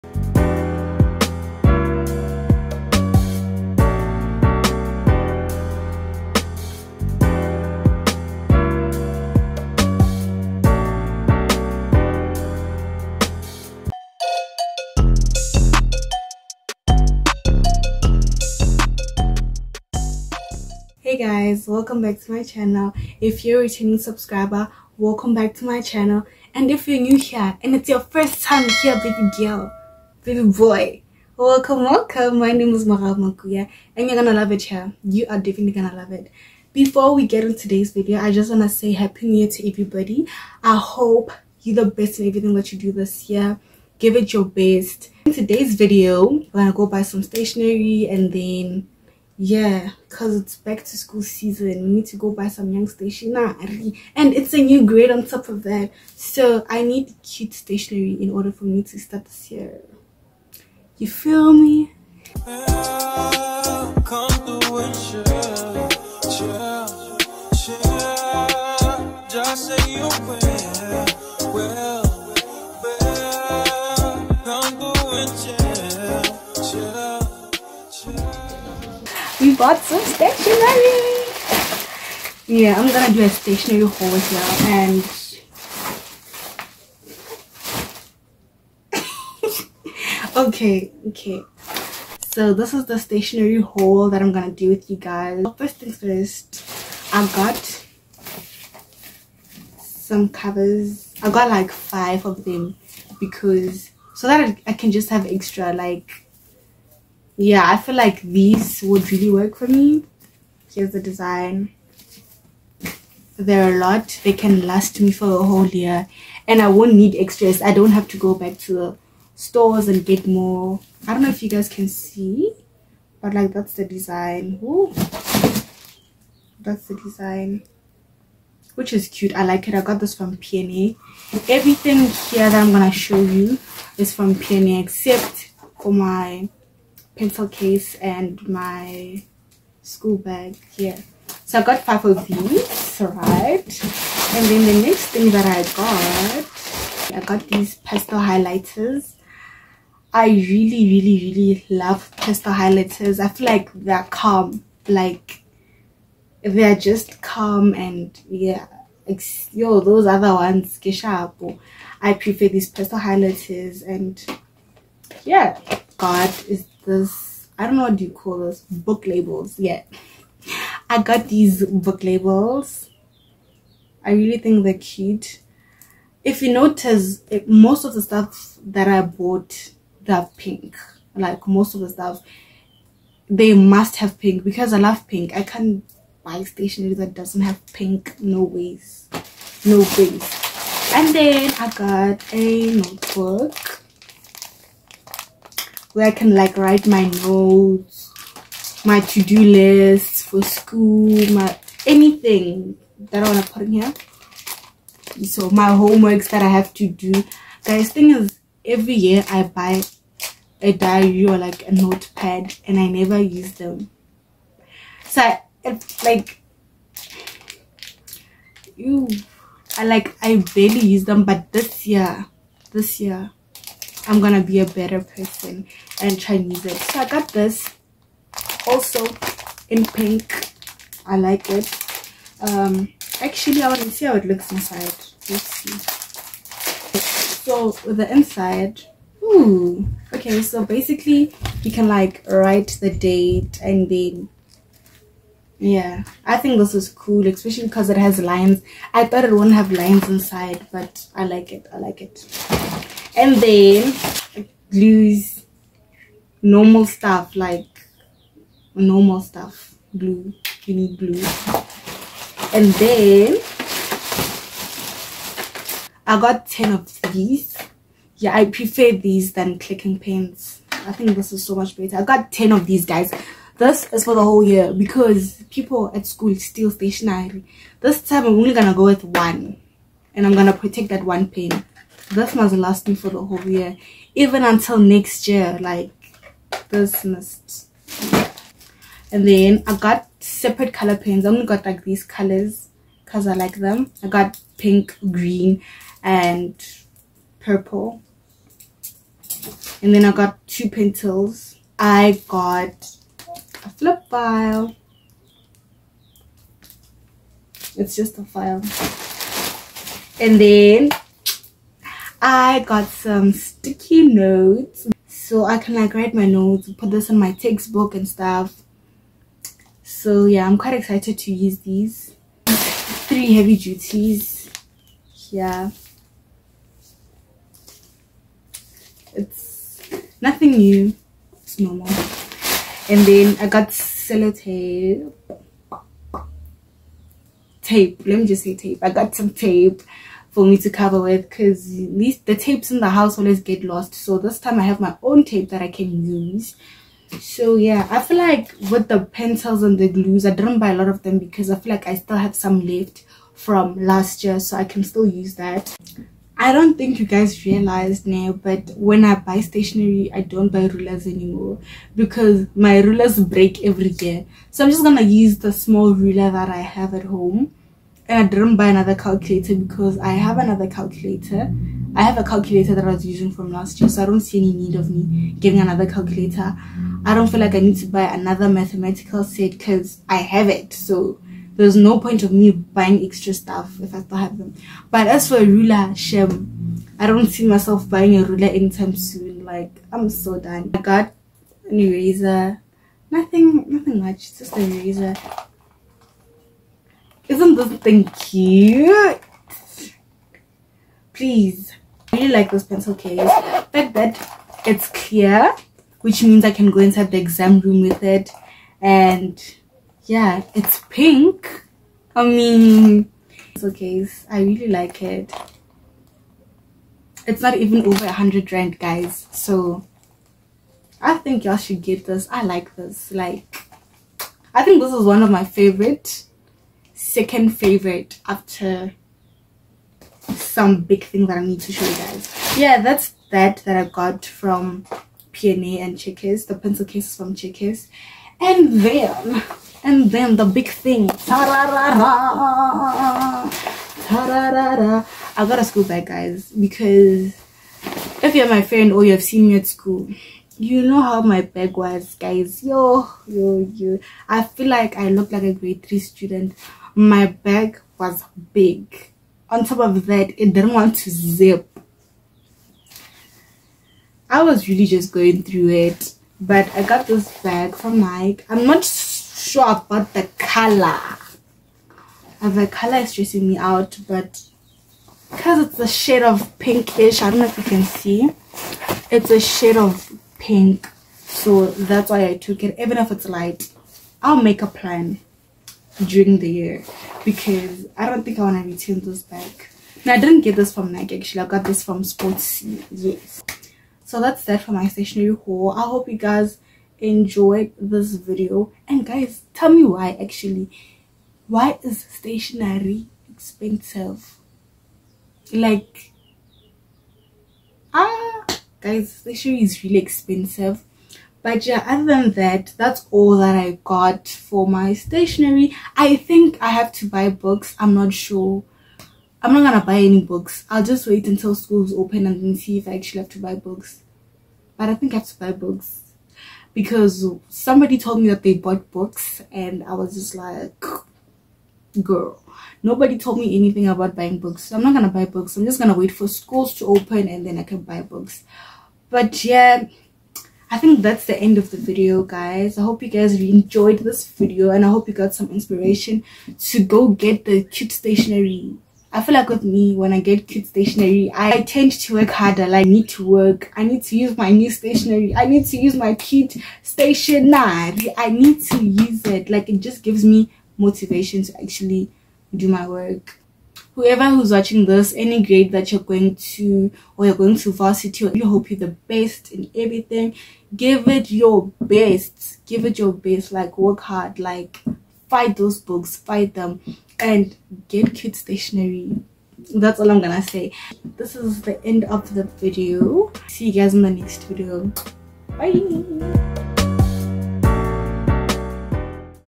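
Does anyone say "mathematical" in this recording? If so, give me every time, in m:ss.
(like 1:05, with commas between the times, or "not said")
6:18.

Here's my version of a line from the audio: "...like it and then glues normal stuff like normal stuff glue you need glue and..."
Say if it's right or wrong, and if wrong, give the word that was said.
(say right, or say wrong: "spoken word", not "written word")
right.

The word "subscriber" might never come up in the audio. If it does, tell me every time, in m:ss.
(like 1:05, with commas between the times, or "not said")
0:23.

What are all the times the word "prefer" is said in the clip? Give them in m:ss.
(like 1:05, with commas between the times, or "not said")
2:42, 4:28.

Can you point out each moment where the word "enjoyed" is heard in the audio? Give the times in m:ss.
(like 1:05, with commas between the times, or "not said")
8:16, 9:03.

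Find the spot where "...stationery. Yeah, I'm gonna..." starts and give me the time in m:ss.
1:20.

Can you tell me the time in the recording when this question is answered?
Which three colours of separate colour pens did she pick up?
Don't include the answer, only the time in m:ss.
4:54.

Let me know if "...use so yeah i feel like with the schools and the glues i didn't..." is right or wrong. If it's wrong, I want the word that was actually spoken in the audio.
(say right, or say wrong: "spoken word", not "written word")
wrong: "pencils", not "schools".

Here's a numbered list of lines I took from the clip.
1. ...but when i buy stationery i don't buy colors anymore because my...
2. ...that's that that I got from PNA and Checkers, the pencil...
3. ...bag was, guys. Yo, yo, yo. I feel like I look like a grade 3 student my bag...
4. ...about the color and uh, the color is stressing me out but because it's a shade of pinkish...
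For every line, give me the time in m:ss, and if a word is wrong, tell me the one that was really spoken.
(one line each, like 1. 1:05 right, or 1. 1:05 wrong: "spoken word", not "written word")
1. 5:58 wrong: "rulers", not "colors"
2. 7:12 right
3. 7:31 right
4. 7:49 right.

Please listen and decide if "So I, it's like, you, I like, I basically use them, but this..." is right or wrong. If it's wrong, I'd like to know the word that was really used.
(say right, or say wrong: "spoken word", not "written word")
wrong: "barely", not "basically".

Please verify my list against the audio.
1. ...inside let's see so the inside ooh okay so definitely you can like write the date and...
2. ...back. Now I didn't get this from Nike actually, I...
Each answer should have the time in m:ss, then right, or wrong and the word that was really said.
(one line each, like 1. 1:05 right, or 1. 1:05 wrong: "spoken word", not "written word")
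1. 3:54 wrong: "basically", not "definitely"
2. 8:09 right.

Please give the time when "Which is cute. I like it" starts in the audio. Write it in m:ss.
2:08.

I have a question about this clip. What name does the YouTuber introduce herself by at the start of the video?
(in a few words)
Mogau Makuya.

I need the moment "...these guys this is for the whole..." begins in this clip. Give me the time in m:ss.
4:32.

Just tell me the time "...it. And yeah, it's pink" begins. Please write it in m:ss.
6:48.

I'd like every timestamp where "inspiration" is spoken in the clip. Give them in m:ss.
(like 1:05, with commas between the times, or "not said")
9:05.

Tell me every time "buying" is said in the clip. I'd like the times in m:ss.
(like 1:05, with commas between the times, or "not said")
6:22, 6:27, 8:54.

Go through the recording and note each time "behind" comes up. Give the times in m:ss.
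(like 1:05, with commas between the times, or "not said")
not said.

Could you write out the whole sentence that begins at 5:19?
So yeah, I'm quite excited to use these.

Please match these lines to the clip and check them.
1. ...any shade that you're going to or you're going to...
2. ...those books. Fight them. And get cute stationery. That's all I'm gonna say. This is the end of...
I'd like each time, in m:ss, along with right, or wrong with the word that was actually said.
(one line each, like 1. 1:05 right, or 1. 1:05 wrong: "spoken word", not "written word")
1. 9:25 wrong: "grade", not "shade"
2. 9:35 right.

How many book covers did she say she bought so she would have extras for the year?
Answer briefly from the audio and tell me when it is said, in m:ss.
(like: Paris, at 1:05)
5, at 1:41.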